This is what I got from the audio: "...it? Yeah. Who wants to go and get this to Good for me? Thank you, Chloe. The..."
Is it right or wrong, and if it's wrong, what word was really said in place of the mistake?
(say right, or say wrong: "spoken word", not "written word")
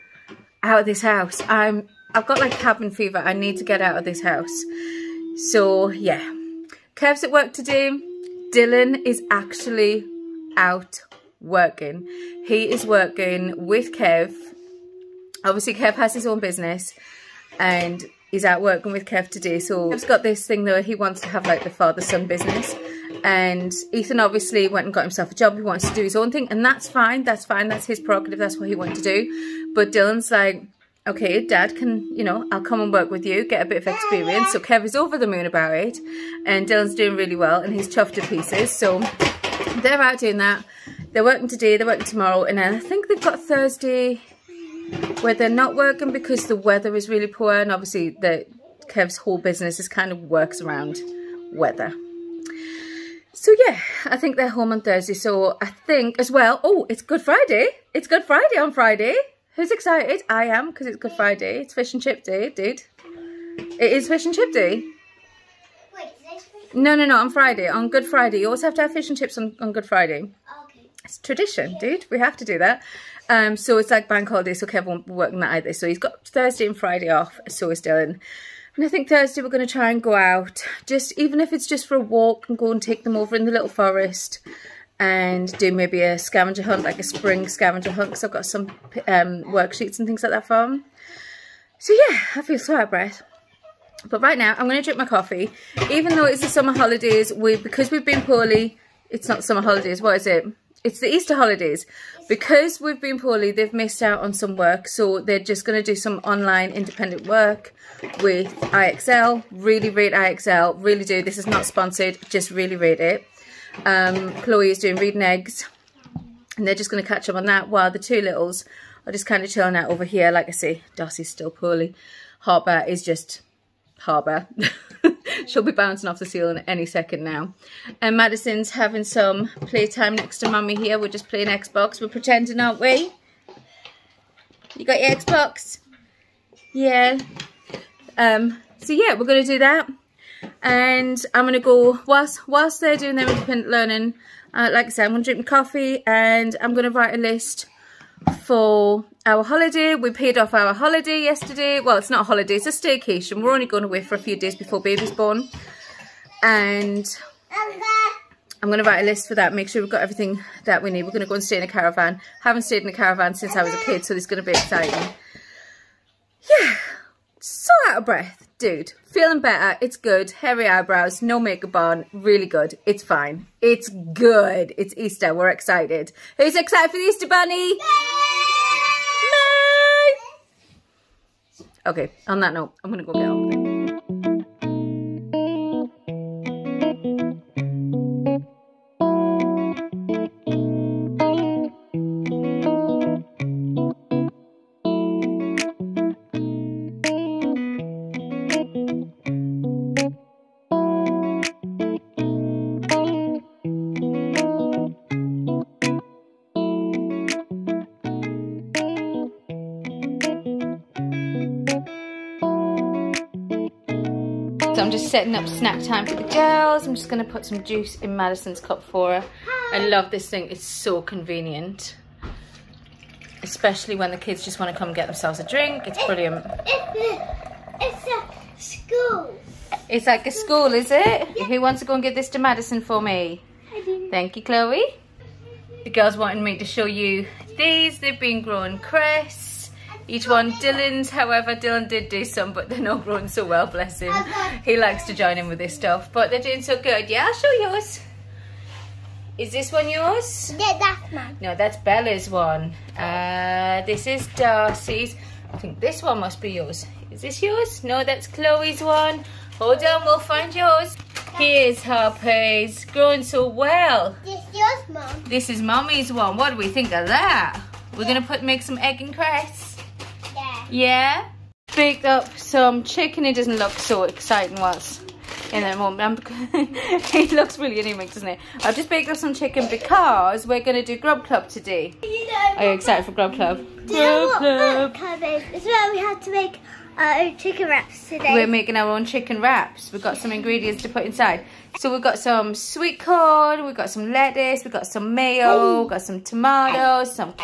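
wrong: "Madison", not "Good".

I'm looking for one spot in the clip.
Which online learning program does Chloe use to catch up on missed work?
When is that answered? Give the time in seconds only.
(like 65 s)
114 s.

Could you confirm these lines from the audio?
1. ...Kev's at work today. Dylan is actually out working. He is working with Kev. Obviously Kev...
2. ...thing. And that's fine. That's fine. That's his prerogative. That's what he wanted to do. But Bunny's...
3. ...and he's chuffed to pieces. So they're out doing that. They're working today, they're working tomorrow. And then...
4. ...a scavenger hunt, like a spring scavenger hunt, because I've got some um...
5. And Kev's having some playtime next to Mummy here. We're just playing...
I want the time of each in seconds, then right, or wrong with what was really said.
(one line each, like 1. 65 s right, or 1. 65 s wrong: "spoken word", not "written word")
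1. 6 s right
2. 26 s wrong: "Dylan", not "Bunny"
3. 37 s right
4. 86 s right
5. 128 s wrong: "Madison", not "Kev".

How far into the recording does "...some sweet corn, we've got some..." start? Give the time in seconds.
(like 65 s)
292 s.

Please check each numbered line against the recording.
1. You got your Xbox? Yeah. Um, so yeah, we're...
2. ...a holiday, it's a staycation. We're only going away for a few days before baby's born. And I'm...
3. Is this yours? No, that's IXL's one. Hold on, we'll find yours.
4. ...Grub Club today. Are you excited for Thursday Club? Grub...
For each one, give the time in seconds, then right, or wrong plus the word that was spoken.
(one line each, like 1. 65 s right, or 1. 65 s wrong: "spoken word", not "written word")
1. 134 s right
2. 152 s right
3. 257 s wrong: "Chloe", not "IXL"
4. 280 s wrong: "Grub", not "Thursday".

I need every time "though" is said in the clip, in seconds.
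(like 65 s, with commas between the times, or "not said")
20 s, 96 s.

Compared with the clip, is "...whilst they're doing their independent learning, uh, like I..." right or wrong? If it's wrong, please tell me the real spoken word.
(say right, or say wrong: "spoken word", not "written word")
right.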